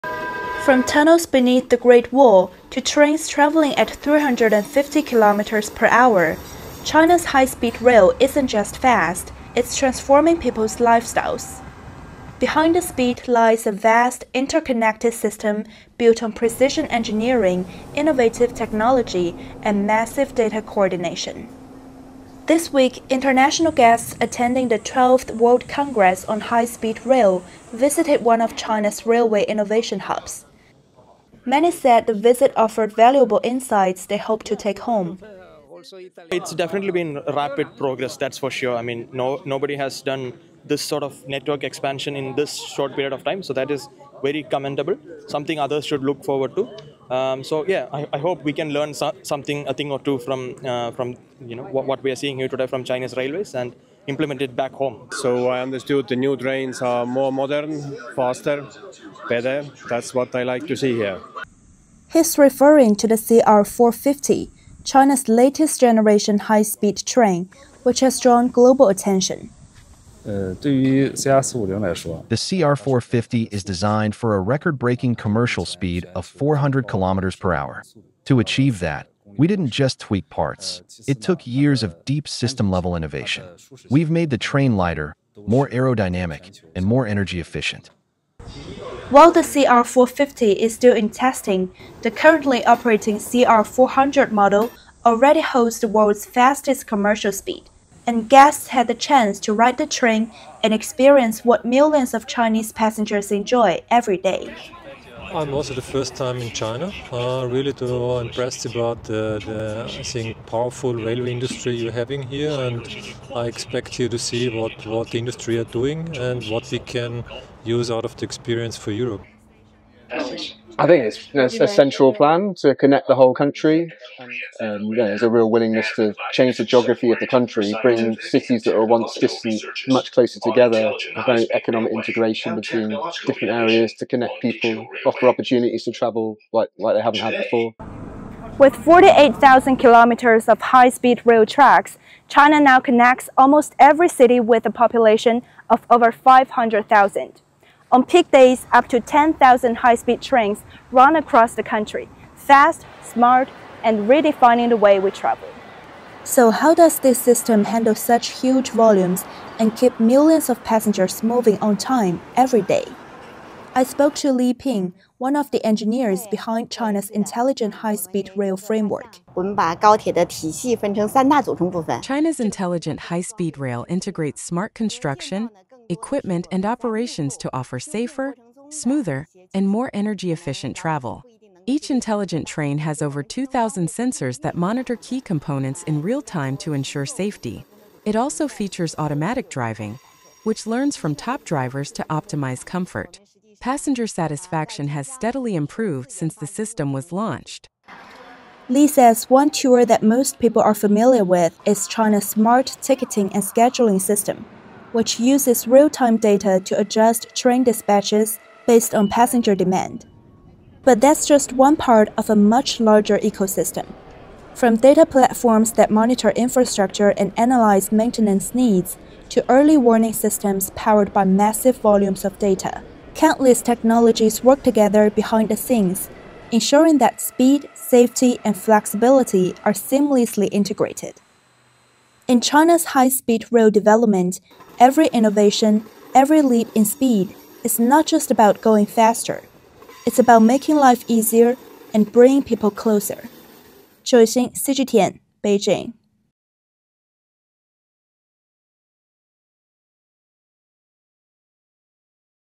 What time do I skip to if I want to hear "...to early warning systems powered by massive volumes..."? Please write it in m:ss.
3:39.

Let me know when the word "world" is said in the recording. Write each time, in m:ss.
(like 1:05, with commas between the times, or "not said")
0:25, 1:35.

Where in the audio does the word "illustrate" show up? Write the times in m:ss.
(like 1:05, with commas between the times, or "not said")
not said.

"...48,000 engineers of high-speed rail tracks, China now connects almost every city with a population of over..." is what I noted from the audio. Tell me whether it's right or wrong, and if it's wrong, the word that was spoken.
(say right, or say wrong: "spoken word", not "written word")
wrong: "kilometers", not "engineers".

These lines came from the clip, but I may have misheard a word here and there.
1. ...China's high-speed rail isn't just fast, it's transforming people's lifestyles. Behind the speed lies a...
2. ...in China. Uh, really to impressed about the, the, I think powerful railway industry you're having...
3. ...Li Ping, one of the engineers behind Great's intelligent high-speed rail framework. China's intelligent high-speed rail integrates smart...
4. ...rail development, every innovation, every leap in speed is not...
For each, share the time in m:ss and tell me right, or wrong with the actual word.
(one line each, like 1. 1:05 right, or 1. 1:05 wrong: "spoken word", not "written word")
1. 0:06 right
2. 1:46 right
3. 2:44 wrong: "China", not "Great"
4. 3:53 right.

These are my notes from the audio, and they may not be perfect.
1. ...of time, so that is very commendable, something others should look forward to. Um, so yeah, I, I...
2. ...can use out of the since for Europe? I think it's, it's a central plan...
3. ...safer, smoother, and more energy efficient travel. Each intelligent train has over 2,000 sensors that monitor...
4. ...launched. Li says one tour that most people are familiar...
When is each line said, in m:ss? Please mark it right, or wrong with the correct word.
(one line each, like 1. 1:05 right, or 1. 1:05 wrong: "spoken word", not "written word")
1. 0:43 right
2. 1:56 wrong: "experience", not "since"
3. 2:57 right
4. 3:17 right.